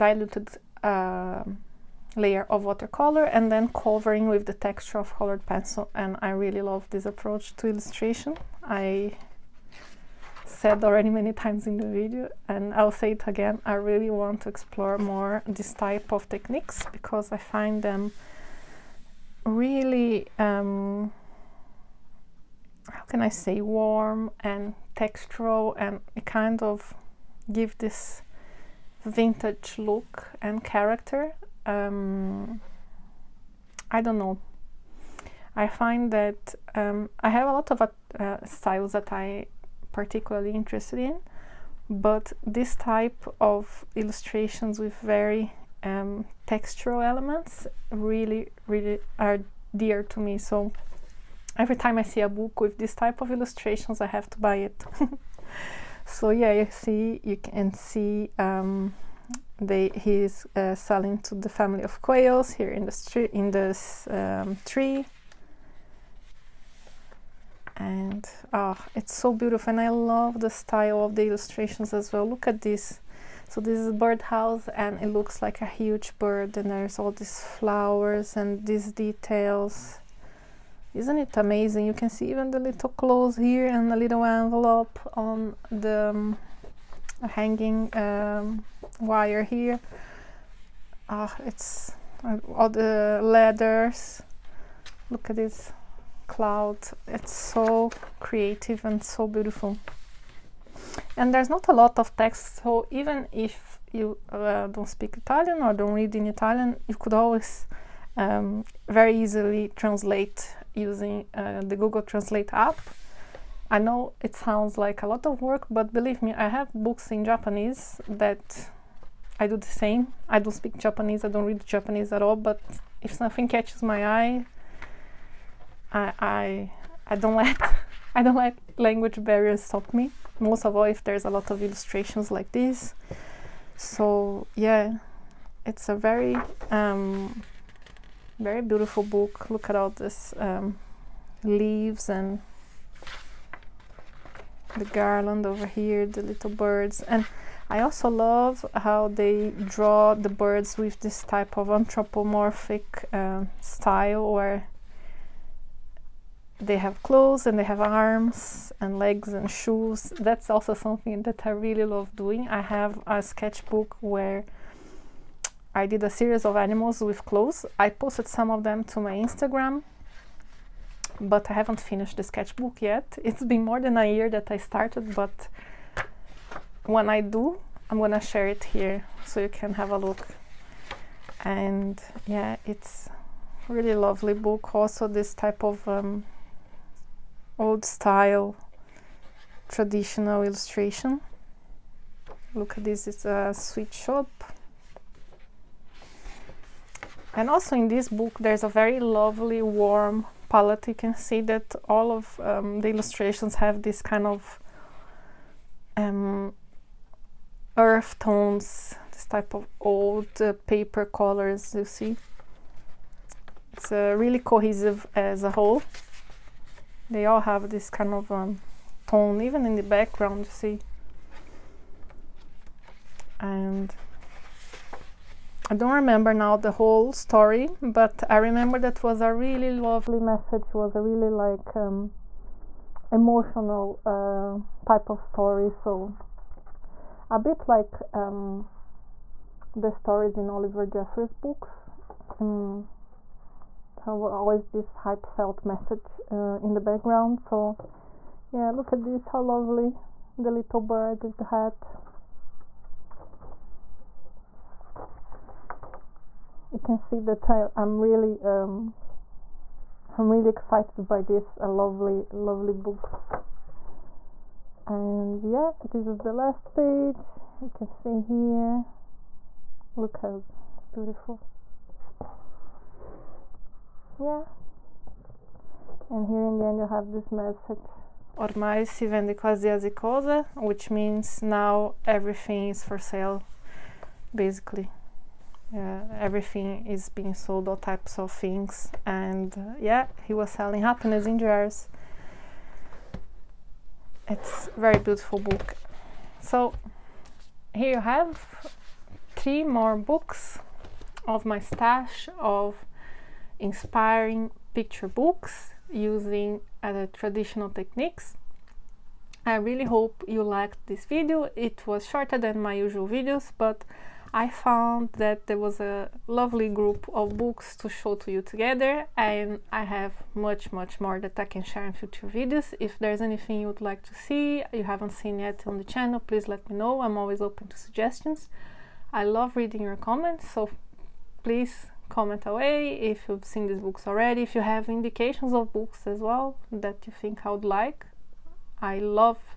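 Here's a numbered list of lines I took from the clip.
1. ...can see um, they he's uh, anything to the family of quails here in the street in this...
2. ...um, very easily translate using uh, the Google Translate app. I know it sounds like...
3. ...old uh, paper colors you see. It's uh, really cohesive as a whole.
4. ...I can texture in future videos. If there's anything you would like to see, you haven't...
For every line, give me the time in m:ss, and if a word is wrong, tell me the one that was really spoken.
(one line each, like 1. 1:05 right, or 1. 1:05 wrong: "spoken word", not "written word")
1. 0:57 wrong: "selling", not "anything"
2. 1:48 right
3. 3:29 right
4. 5:21 wrong: "share", not "texture".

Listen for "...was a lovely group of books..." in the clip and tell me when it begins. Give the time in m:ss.
5:15.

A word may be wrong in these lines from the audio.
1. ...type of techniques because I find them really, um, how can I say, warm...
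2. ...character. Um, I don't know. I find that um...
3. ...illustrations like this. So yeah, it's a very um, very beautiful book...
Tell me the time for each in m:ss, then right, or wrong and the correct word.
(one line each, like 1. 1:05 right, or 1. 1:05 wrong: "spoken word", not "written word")
1. 0:15 right
2. 0:30 right
3. 2:11 right.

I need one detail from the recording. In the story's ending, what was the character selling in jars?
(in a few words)
happiness.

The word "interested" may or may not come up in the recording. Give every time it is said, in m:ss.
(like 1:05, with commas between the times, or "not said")
0:40.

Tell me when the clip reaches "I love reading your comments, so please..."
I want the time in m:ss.
5:29.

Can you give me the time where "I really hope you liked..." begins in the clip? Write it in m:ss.
5:09.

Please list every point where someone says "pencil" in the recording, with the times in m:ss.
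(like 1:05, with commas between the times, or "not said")
0:05.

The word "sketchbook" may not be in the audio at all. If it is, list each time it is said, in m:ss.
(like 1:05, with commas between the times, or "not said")
2:43, 2:52.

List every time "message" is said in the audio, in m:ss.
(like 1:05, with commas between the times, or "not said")
3:50, 4:05, 4:37.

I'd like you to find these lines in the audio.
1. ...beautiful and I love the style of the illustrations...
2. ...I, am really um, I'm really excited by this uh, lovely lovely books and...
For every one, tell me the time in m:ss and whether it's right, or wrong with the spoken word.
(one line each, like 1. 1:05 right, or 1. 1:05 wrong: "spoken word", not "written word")
1. 1:09 right
2. 4:17 right.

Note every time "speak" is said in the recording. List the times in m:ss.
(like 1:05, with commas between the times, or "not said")
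1:44, 2:00.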